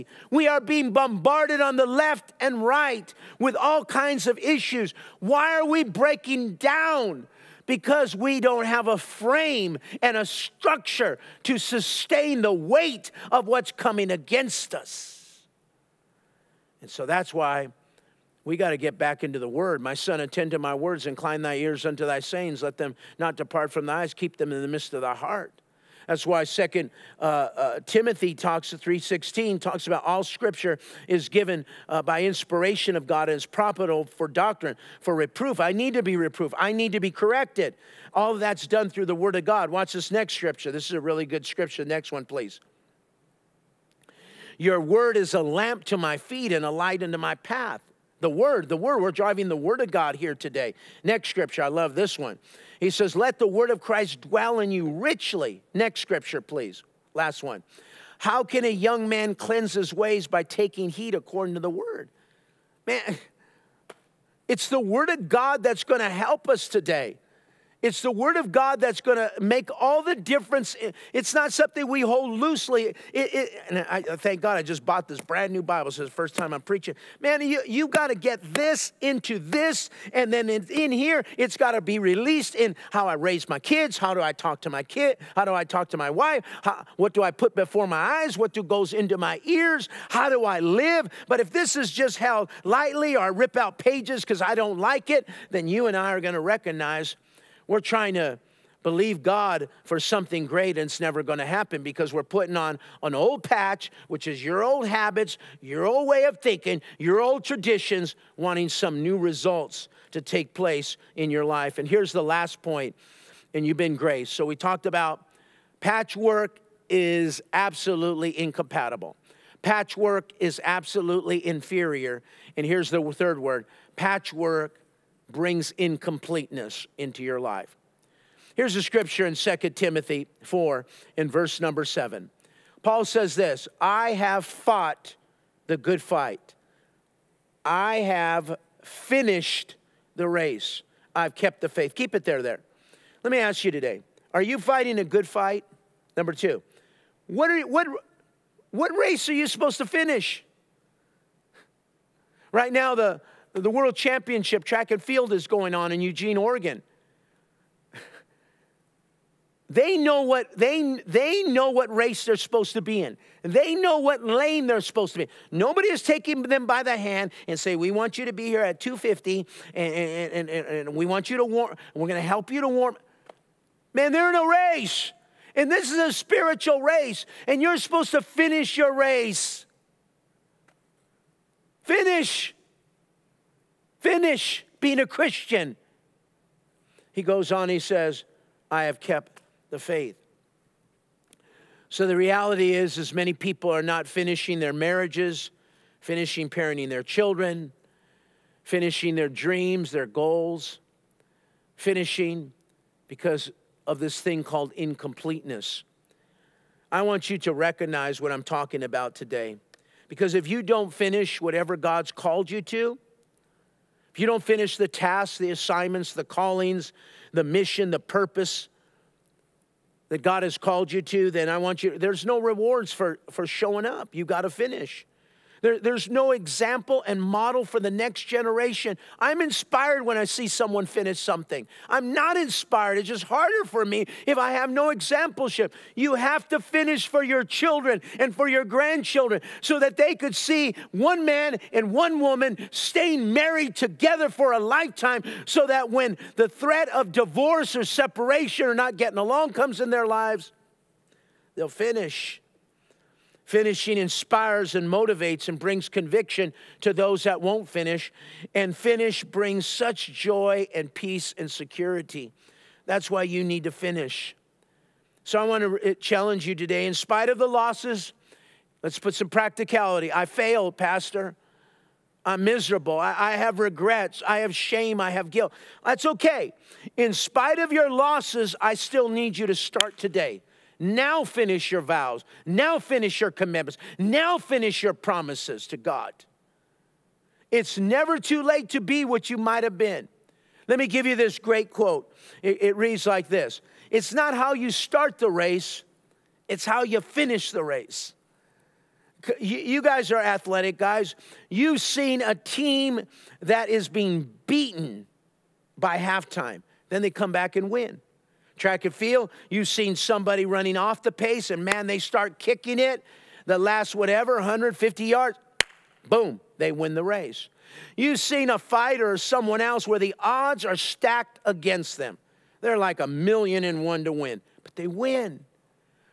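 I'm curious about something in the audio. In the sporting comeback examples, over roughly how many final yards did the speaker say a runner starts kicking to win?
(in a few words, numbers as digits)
150.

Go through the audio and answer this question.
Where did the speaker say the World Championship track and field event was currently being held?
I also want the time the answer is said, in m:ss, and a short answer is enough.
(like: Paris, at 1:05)
Eugene, Oregon, at 2:36.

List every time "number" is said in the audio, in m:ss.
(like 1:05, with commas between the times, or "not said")
2:11, 2:26.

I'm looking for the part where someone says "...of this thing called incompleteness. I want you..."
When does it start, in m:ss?
3:23.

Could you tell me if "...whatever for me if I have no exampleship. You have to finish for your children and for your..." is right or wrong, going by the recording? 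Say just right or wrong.
wrong.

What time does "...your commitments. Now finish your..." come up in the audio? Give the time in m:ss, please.
4:43.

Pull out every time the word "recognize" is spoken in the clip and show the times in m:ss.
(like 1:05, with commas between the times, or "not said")
1:36, 3:27.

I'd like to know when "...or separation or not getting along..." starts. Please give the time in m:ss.
4:07.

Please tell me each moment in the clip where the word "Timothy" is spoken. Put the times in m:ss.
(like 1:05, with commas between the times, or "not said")
0:27, 2:09.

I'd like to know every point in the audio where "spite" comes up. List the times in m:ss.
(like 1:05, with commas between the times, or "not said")
4:26, 4:37.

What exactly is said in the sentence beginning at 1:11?
It's not something we hold loosely.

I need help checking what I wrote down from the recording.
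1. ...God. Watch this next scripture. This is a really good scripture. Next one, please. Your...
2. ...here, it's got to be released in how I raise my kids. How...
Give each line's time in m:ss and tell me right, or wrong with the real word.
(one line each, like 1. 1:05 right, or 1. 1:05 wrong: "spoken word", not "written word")
1. 0:39 right
2. 1:20 right.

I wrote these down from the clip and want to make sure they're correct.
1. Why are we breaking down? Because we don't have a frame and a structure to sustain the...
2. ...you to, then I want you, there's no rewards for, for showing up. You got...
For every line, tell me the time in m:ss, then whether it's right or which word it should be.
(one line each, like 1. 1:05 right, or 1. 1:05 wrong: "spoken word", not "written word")
1. 0:05 right
2. 3:40 right.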